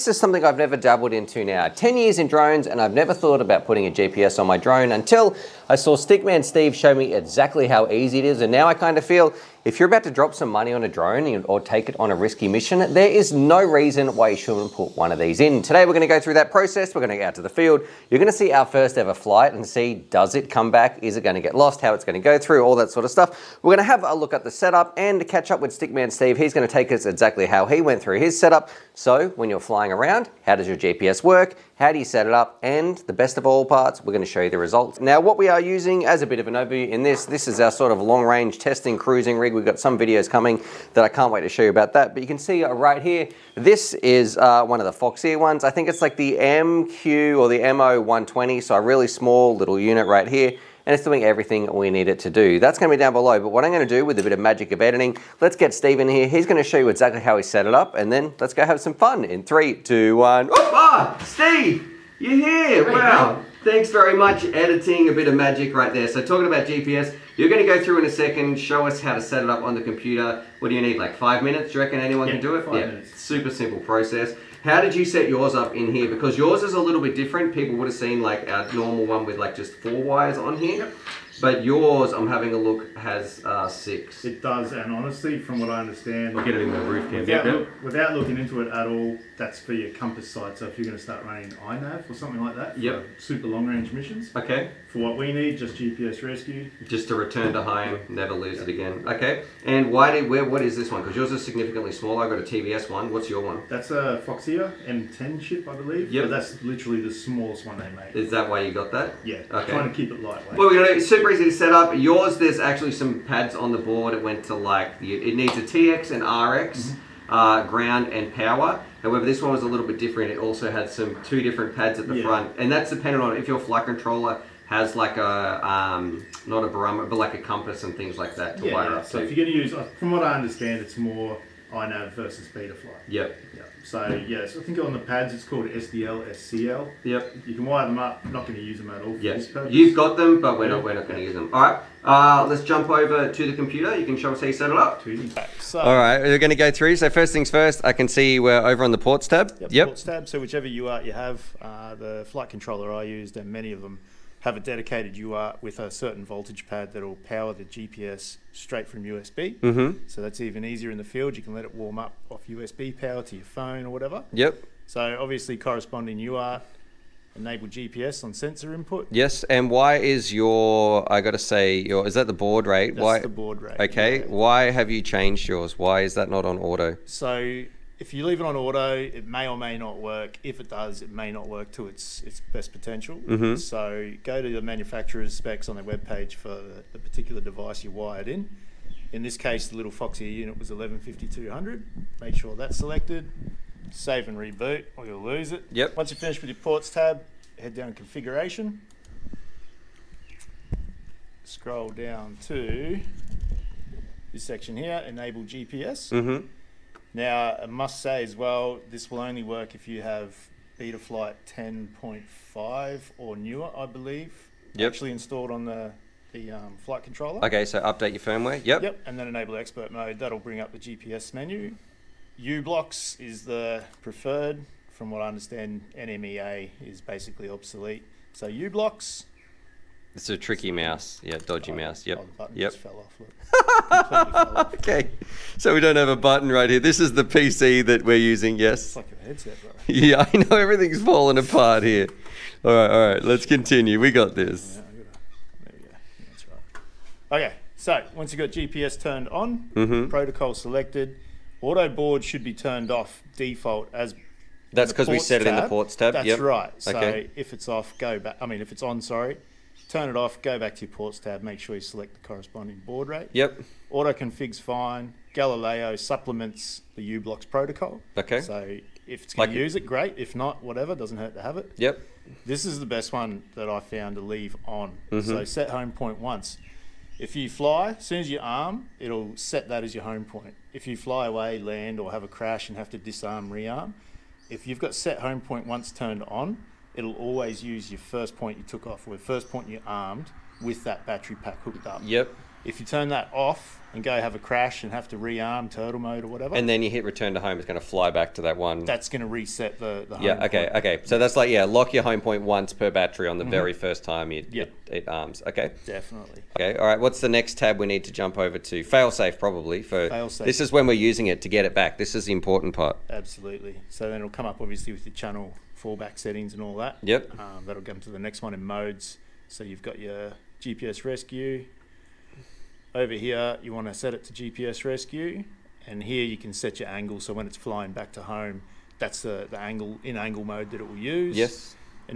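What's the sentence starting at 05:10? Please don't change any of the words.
This is when we're using it to get it back.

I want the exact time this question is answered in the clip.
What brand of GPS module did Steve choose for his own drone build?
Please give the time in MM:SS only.
01:42.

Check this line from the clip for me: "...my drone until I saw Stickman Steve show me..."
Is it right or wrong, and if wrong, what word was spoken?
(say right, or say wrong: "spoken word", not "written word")
right.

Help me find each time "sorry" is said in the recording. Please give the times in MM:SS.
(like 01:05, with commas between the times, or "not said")
04:19.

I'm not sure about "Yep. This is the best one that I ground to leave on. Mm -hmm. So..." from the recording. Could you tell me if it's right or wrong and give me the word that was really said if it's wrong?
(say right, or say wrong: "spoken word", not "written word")
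wrong: "found", not "ground".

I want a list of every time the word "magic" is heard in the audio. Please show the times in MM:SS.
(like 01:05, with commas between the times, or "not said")
00:54, 01:05.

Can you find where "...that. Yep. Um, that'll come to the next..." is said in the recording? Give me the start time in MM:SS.
05:16.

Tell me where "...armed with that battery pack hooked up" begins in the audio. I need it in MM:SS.
04:49.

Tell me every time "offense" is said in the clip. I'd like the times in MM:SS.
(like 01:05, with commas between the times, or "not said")
not said.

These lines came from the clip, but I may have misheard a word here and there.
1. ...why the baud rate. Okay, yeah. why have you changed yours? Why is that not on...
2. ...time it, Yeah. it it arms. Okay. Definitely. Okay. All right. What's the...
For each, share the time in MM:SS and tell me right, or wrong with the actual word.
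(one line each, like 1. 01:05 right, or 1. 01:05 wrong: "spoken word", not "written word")
1. 02:53 right
2. 05:04 right.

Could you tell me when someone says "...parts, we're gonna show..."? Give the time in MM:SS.
00:33.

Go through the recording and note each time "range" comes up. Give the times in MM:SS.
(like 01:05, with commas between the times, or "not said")
00:38, 01:33.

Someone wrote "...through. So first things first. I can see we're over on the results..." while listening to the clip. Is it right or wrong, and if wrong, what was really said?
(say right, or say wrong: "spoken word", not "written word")
wrong: "ports", not "results".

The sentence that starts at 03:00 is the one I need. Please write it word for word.
If it does, it may not work to its its best potential.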